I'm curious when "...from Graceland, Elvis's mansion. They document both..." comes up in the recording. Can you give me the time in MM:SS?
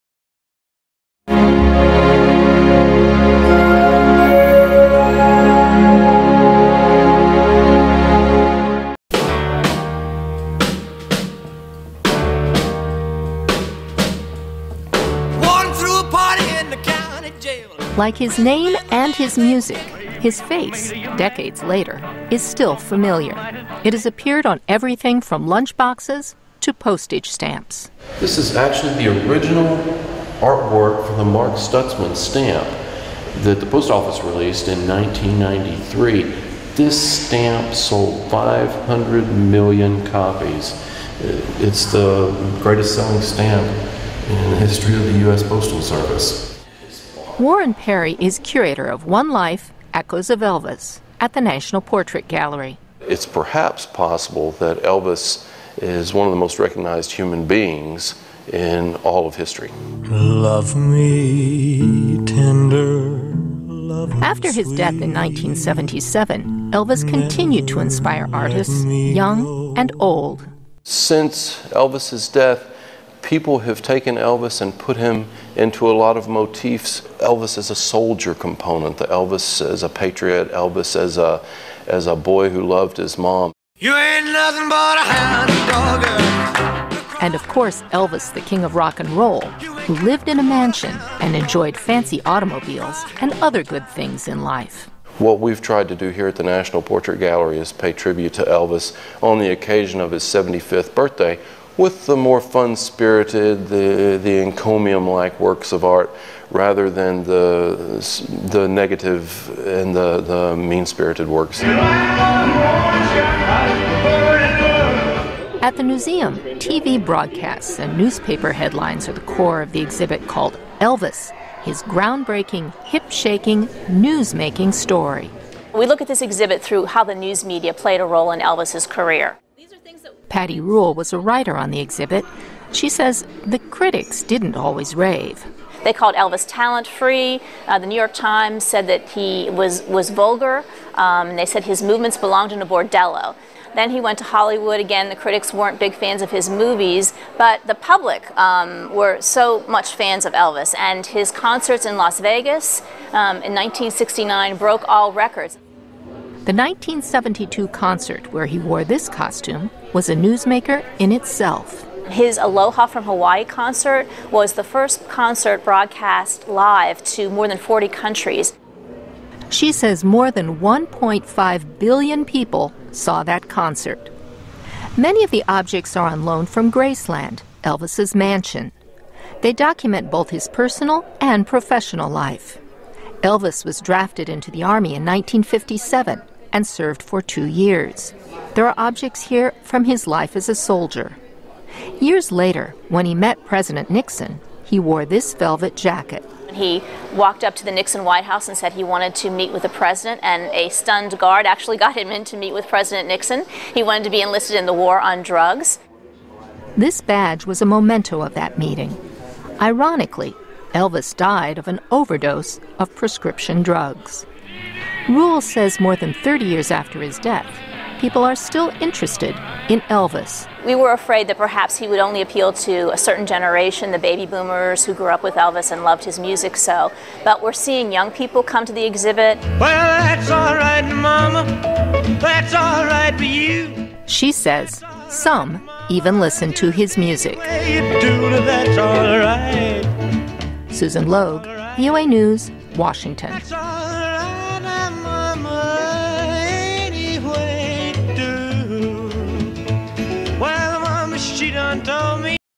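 02:56.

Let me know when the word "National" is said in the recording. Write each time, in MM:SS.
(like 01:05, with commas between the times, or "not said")
00:51, 01:36.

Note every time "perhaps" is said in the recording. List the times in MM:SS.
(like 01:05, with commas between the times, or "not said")
00:53, 03:41.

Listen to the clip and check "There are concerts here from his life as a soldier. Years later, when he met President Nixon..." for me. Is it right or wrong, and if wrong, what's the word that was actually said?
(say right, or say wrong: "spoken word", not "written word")
wrong: "objects", not "concerts".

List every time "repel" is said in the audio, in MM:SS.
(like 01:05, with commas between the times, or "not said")
not said.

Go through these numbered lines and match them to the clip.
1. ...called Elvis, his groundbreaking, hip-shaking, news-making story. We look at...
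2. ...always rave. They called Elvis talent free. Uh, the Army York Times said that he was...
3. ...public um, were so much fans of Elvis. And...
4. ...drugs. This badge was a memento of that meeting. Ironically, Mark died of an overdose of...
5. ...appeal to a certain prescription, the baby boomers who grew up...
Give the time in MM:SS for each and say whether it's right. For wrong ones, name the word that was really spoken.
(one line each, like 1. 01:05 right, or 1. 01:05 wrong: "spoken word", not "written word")
1. 02:00 right
2. 02:14 wrong: "New", not "Army"
3. 02:27 right
4. 03:25 wrong: "Elvis", not "Mark"
5. 03:42 wrong: "generation", not "prescription".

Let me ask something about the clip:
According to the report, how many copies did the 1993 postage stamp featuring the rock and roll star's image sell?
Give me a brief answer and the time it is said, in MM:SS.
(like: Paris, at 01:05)
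500 million, at 00:38.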